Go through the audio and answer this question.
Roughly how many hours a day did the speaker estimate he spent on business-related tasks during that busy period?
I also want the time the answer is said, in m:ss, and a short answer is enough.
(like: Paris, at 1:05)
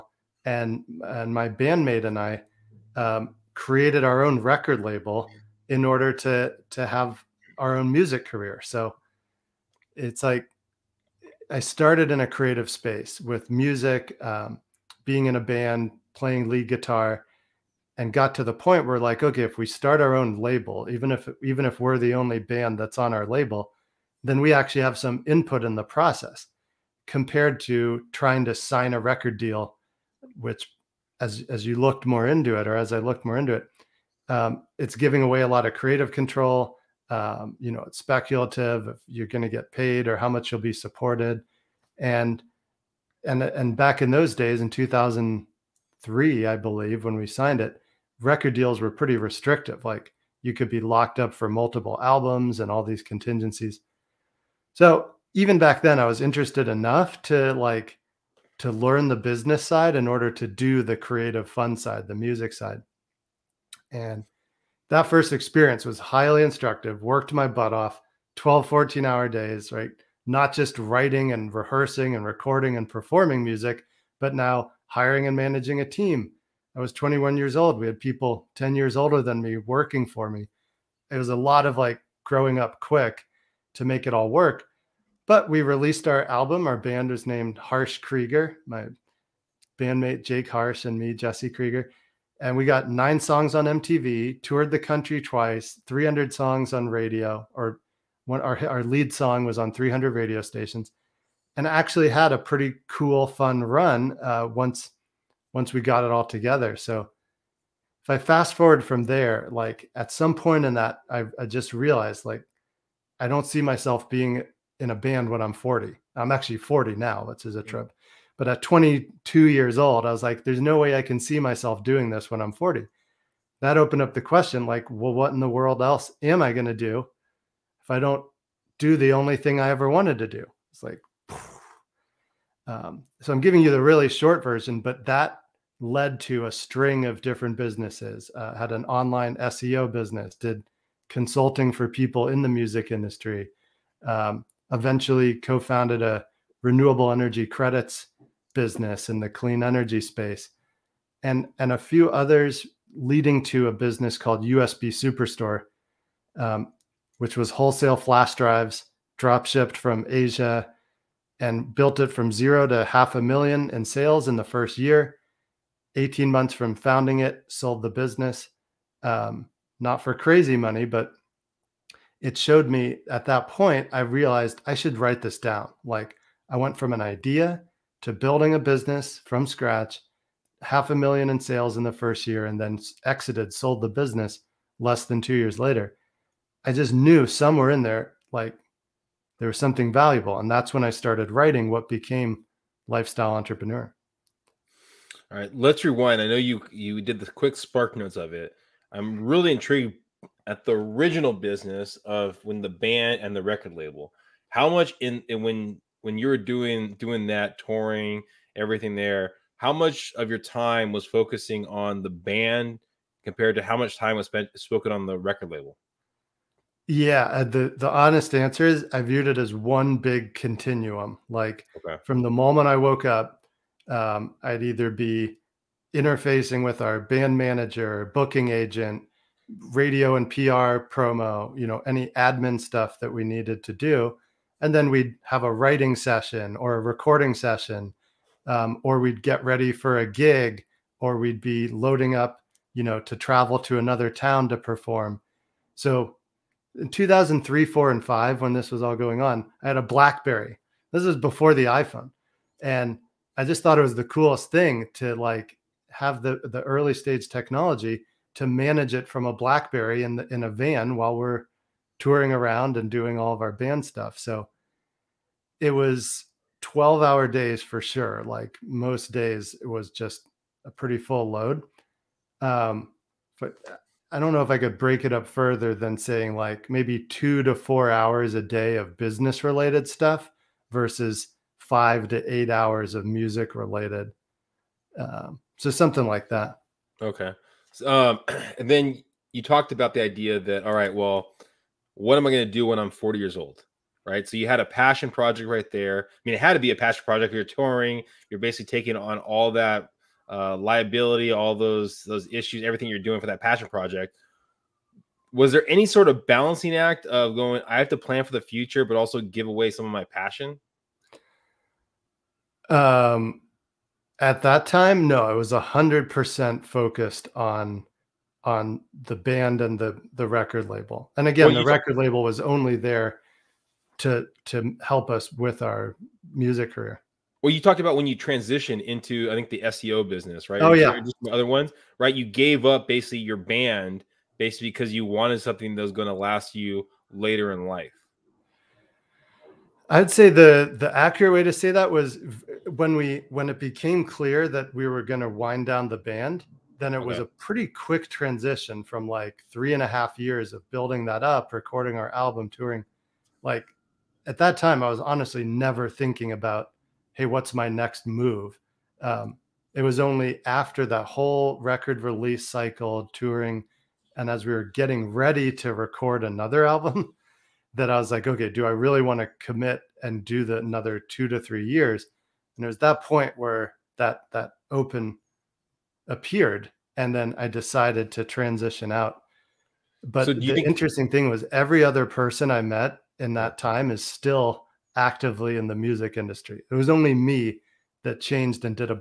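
2 to 4 hours, at 4:37.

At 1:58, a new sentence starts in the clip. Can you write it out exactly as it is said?
But at 22 years old, I was like, there's no way I can see myself doing this when I'm 40.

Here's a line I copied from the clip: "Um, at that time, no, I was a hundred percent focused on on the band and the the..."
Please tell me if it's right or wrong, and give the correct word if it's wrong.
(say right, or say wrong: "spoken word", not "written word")
right.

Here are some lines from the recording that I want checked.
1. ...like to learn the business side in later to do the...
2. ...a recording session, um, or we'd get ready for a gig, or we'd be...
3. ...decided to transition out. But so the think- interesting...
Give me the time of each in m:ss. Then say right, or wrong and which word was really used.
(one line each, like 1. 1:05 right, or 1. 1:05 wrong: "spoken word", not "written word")
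1. 0:57 wrong: "order", not "later"
2. 3:56 right
3. 6:17 right.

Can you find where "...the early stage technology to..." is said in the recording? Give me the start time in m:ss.
4:16.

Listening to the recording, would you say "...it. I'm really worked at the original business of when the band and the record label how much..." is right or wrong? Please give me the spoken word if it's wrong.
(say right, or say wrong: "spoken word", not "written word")
wrong: "intrigued", not "worked".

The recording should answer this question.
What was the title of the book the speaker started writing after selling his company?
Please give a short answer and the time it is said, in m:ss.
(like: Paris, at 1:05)
Lifestyle Entrepreneur, at 3:12.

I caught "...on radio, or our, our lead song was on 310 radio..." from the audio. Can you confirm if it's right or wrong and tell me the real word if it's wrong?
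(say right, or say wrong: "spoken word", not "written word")
wrong: "300", not "310".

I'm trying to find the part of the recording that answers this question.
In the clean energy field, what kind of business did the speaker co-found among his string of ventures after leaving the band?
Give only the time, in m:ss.
2:26.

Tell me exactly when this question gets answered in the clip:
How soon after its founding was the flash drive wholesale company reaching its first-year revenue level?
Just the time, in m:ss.
2:45.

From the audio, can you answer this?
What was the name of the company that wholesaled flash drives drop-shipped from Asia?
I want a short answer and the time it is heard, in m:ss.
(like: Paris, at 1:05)
USB Superstore, at 2:34.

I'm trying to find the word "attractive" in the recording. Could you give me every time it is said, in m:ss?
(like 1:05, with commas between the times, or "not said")
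not said.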